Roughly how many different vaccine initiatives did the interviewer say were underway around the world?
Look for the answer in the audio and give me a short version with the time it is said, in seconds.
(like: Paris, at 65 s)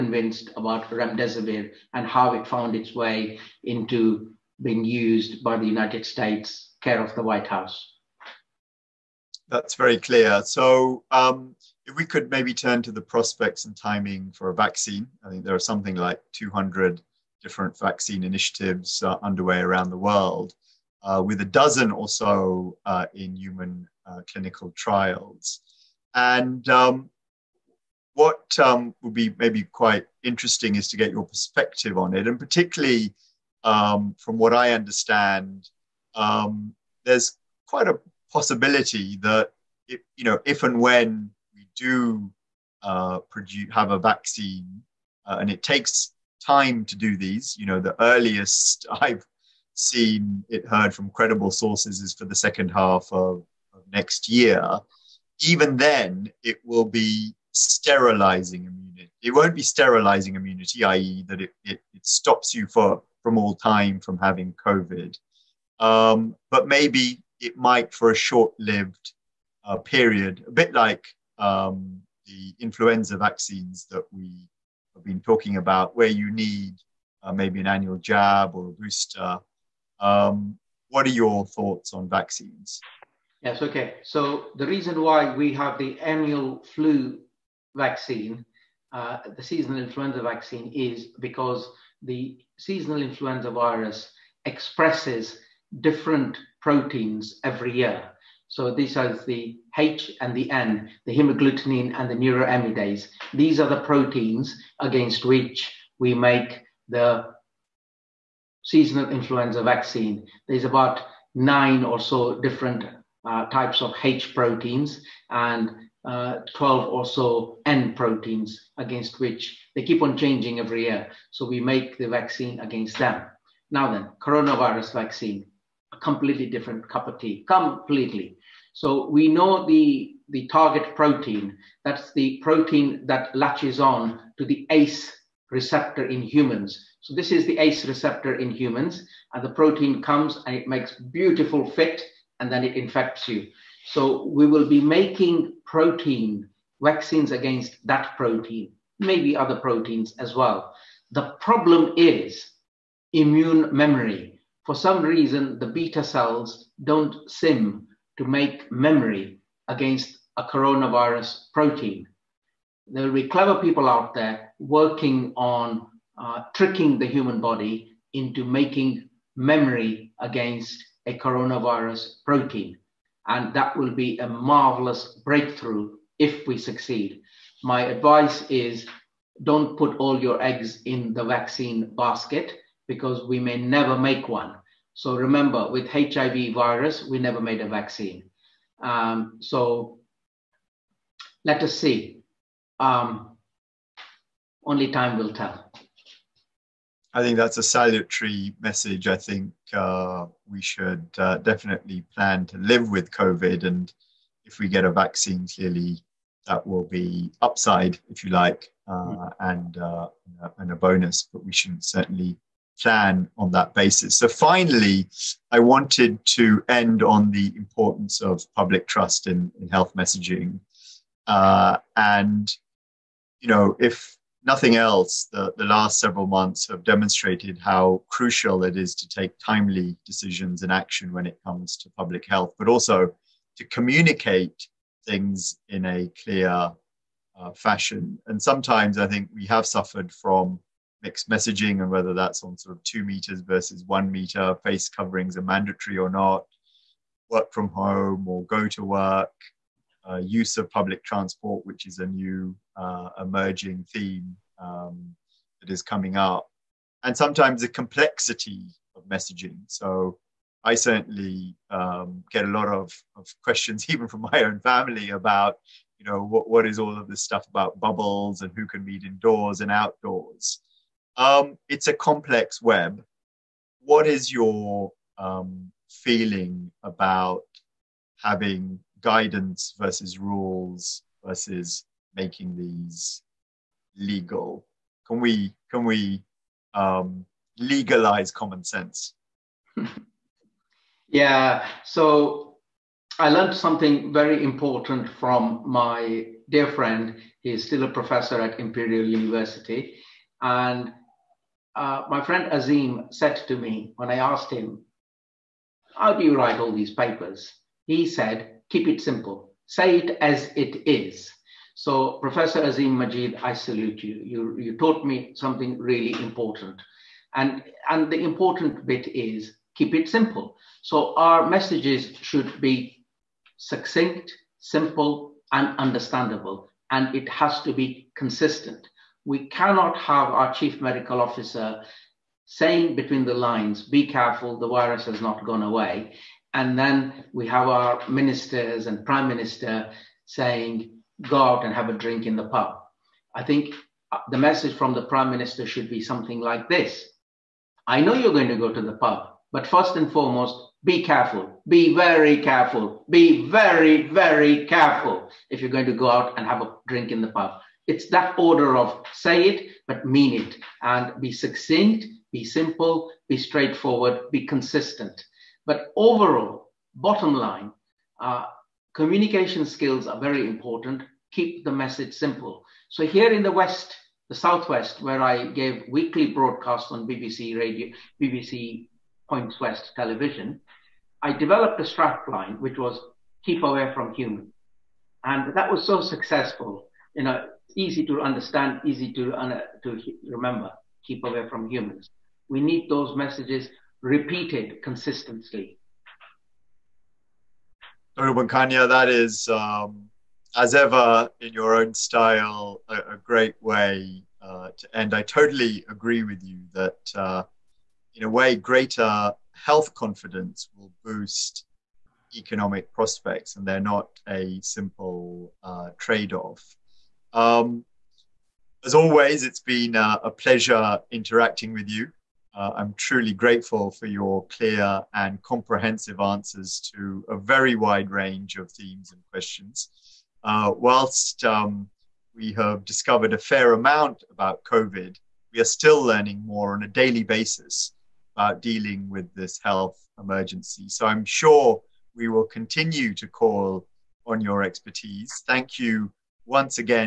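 200, at 16 s.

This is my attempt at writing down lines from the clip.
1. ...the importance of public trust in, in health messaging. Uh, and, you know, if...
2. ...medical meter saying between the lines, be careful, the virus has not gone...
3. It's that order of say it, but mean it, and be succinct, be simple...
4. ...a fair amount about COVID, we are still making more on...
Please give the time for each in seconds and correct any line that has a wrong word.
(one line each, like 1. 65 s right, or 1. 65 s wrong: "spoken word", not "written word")
1. 217 s right
2. 330 s wrong: "officer", not "meter"
3. 357 s right
4. 433 s wrong: "learning", not "making".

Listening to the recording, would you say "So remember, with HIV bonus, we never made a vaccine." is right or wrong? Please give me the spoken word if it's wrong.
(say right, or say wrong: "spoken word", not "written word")
wrong: "virus", not "bonus".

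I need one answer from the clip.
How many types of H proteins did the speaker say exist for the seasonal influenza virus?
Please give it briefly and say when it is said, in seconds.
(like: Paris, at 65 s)
9, at 111 s.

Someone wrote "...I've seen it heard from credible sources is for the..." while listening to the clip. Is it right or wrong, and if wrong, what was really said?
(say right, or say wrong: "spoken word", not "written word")
right.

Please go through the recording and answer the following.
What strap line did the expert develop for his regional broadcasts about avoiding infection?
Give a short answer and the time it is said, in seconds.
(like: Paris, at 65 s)
Keep away from humans, at 383 s.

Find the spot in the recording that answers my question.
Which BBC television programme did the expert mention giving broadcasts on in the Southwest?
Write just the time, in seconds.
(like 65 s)
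378 s.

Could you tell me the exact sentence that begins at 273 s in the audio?
What is your um, feeling about having guidance versus rules versus making these legal?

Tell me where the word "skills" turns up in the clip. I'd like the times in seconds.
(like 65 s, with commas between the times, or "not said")
369 s.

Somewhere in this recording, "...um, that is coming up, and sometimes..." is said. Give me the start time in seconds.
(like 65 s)
254 s.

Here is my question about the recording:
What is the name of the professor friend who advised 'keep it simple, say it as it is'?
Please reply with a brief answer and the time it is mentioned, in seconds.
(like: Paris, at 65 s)
Azeem Majeed, at 312 s.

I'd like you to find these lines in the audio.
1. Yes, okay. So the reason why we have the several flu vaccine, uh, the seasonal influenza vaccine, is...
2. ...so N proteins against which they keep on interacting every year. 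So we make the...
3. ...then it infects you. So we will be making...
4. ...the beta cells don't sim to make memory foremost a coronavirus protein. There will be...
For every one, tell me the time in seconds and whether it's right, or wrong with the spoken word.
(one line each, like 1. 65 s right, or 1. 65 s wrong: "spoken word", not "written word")
1. 83 s wrong: "annual", not "several"
2. 117 s wrong: "changing", not "interacting"
3. 142 s right
4. 155 s wrong: "against", not "foremost".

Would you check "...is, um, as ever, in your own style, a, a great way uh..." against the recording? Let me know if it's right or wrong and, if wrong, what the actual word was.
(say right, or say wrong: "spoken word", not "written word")
right.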